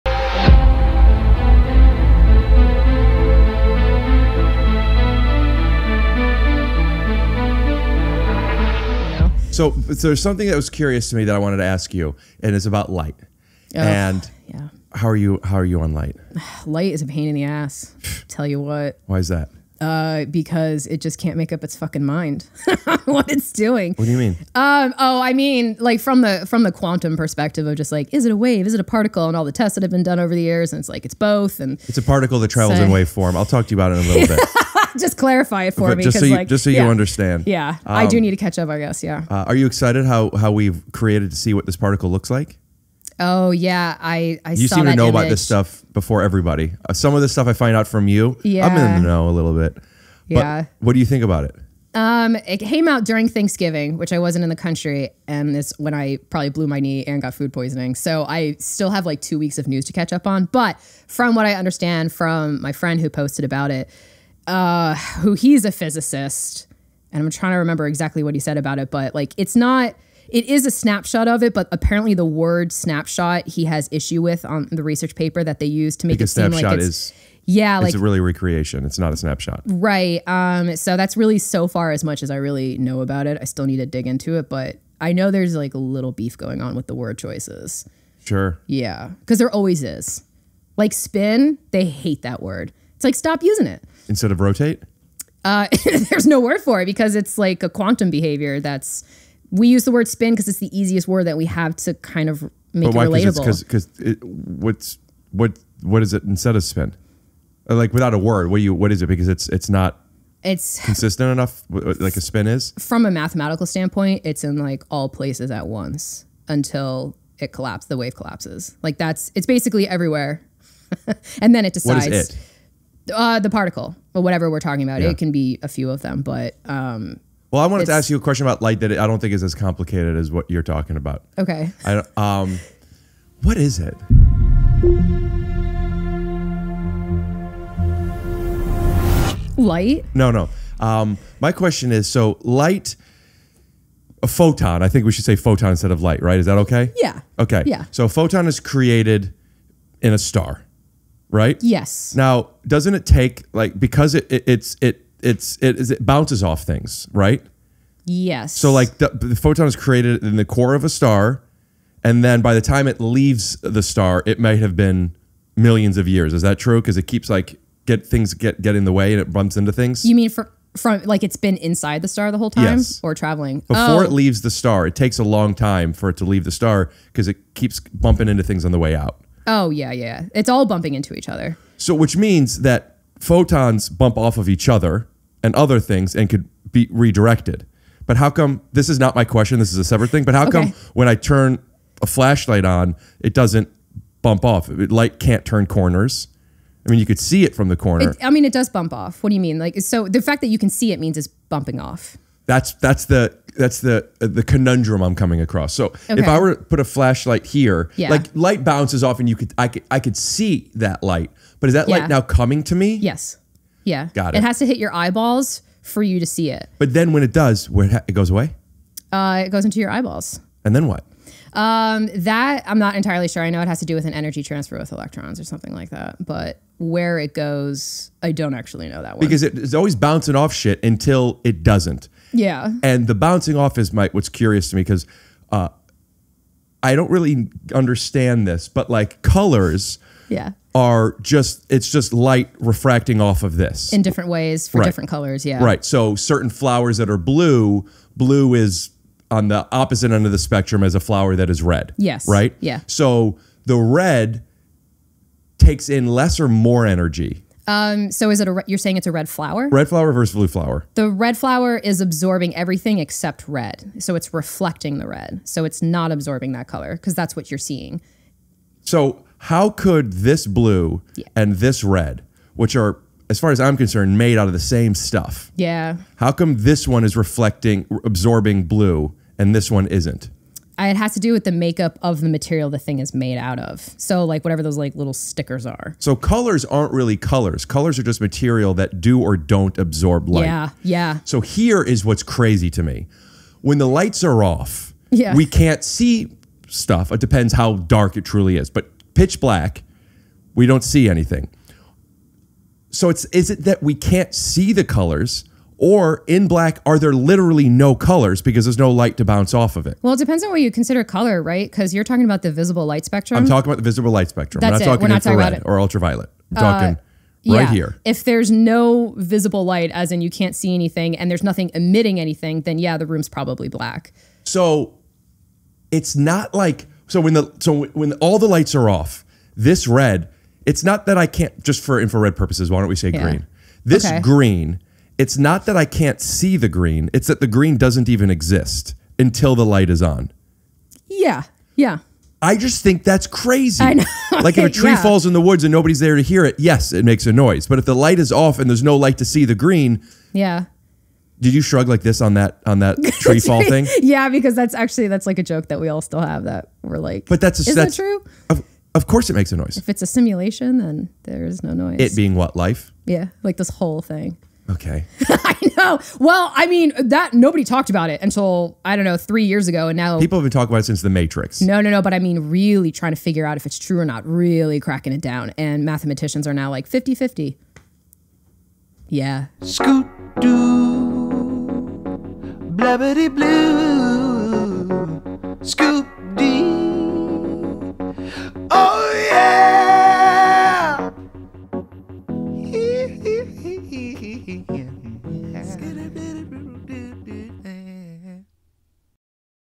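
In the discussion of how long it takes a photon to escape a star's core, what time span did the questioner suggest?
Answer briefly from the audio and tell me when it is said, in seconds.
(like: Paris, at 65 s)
Millions of years, at 165 s.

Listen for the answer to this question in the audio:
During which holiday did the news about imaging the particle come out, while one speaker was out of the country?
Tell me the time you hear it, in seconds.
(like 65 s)
53 s.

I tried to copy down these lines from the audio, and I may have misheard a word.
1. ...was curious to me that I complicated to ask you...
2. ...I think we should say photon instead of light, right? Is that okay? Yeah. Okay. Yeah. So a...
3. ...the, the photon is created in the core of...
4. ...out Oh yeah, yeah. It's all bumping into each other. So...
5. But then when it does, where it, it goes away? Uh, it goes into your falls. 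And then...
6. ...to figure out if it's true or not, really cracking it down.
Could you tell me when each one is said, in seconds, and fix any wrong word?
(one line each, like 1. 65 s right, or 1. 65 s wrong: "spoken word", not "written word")
1. 10 s wrong: "wanted", not "complicated"
2. 144 s right
3. 158 s right
4. 178 s right
5. 216 s wrong: "eyeballs", not "falls"
6. 373 s right.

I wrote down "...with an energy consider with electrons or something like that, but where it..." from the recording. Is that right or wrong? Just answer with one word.
wrong.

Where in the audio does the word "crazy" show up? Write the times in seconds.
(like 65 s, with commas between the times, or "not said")
292 s, 343 s.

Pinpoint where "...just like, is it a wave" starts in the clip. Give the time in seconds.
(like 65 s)
27 s.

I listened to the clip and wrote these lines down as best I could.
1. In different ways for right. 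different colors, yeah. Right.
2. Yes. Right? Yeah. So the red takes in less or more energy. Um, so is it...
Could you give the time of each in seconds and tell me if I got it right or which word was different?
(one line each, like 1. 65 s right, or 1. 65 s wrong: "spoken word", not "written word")
1. 243 s right
2. 251 s right.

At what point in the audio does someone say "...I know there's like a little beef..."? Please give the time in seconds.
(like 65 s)
84 s.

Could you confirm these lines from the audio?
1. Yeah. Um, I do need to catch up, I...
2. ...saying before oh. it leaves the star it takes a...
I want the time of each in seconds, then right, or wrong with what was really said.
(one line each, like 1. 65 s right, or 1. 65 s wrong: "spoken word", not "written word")
1. 37 s right
2. 173 s wrong: "traveling", not "saying".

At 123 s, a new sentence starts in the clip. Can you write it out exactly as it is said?
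Uh, the particle or whatever we're talking about.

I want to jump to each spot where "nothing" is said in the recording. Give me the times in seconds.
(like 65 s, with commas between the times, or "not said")
321 s.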